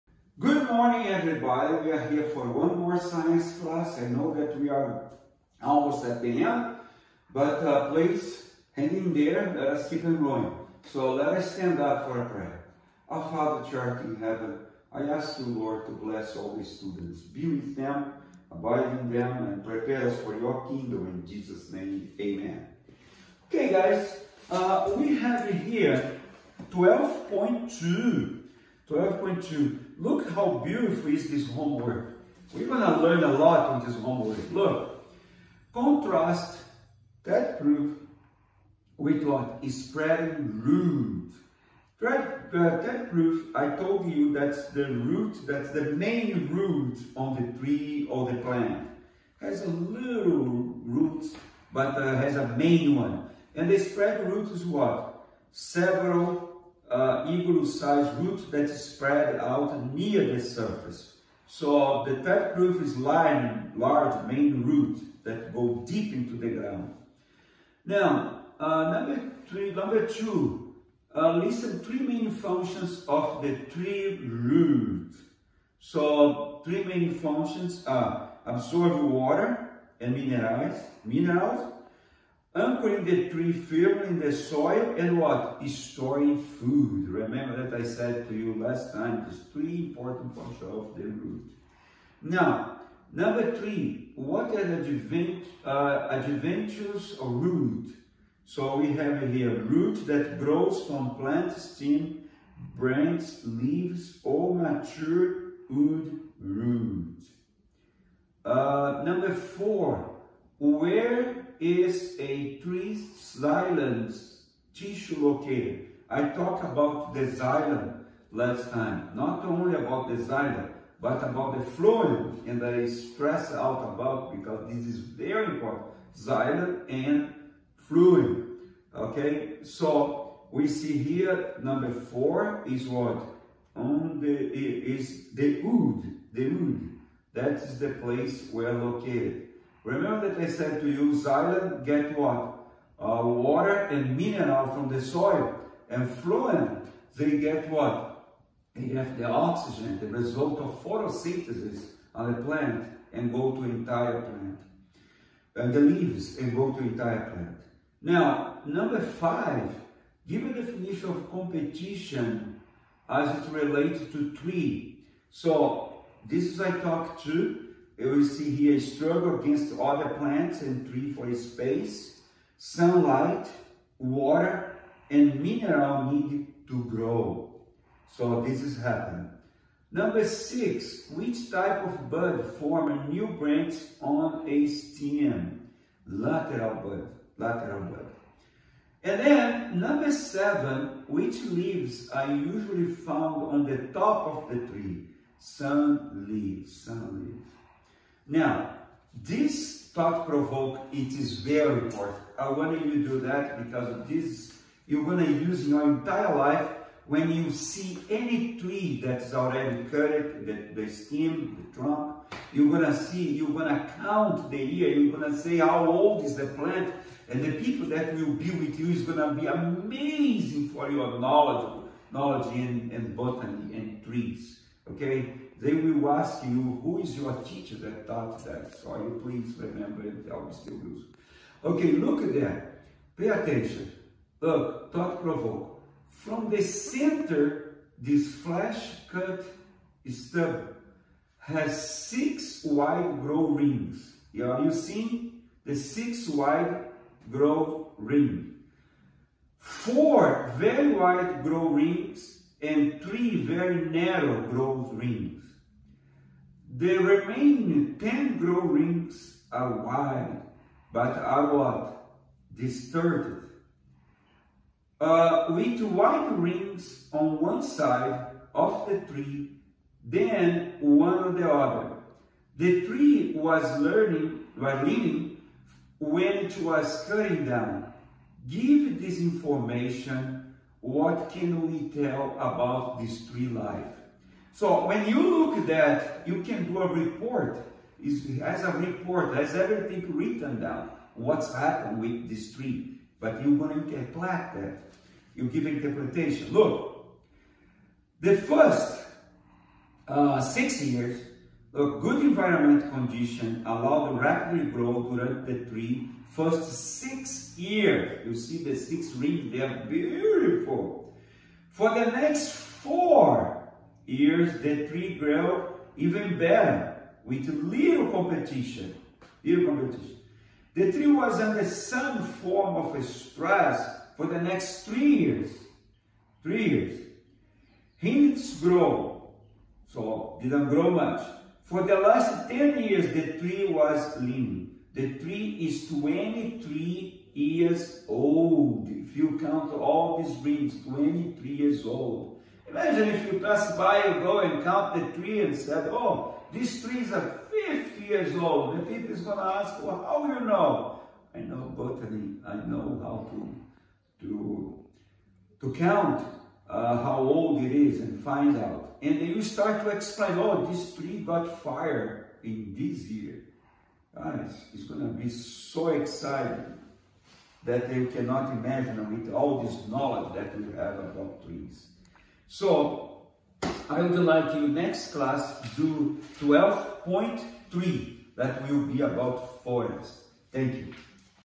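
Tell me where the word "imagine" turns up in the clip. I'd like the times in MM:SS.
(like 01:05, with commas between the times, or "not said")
05:42, 06:08.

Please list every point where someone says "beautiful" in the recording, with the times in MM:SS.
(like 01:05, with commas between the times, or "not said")
00:30, 05:09.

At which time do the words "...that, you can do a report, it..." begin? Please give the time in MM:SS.
04:45.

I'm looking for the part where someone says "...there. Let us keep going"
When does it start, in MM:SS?
00:09.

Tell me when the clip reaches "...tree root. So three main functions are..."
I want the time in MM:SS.
01:13.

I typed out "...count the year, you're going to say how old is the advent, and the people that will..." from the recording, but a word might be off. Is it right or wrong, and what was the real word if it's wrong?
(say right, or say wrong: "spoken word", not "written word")
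wrong: "plant", not "advent".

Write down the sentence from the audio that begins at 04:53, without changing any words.
But you're going to interpret that.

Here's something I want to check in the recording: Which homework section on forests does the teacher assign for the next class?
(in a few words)
12.3.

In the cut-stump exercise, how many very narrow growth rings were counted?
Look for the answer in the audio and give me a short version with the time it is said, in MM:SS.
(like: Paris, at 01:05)
3, at 04:13.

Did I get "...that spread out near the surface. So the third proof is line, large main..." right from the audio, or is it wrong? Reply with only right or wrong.
right.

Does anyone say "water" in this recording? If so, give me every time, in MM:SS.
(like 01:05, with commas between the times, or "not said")
01:19, 02:23, 02:53.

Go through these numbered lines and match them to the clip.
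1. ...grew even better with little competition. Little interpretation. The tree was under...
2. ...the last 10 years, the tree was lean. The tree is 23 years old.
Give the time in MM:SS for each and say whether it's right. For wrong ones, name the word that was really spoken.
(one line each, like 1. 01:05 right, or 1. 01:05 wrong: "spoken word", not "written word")
1. 05:15 wrong: "competition", not "interpretation"
2. 05:31 right.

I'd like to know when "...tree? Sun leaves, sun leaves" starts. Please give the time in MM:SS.
03:14.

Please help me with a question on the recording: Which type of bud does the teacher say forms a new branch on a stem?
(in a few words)
Lateral bud.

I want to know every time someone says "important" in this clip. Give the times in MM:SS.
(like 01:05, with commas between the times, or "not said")
01:29, 02:05, 03:21.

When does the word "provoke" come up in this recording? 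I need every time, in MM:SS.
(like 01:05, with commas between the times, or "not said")
03:20, 03:55.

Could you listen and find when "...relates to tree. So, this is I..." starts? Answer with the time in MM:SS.
02:43.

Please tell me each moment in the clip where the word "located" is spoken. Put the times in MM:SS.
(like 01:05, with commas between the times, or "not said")
01:55, 02:18.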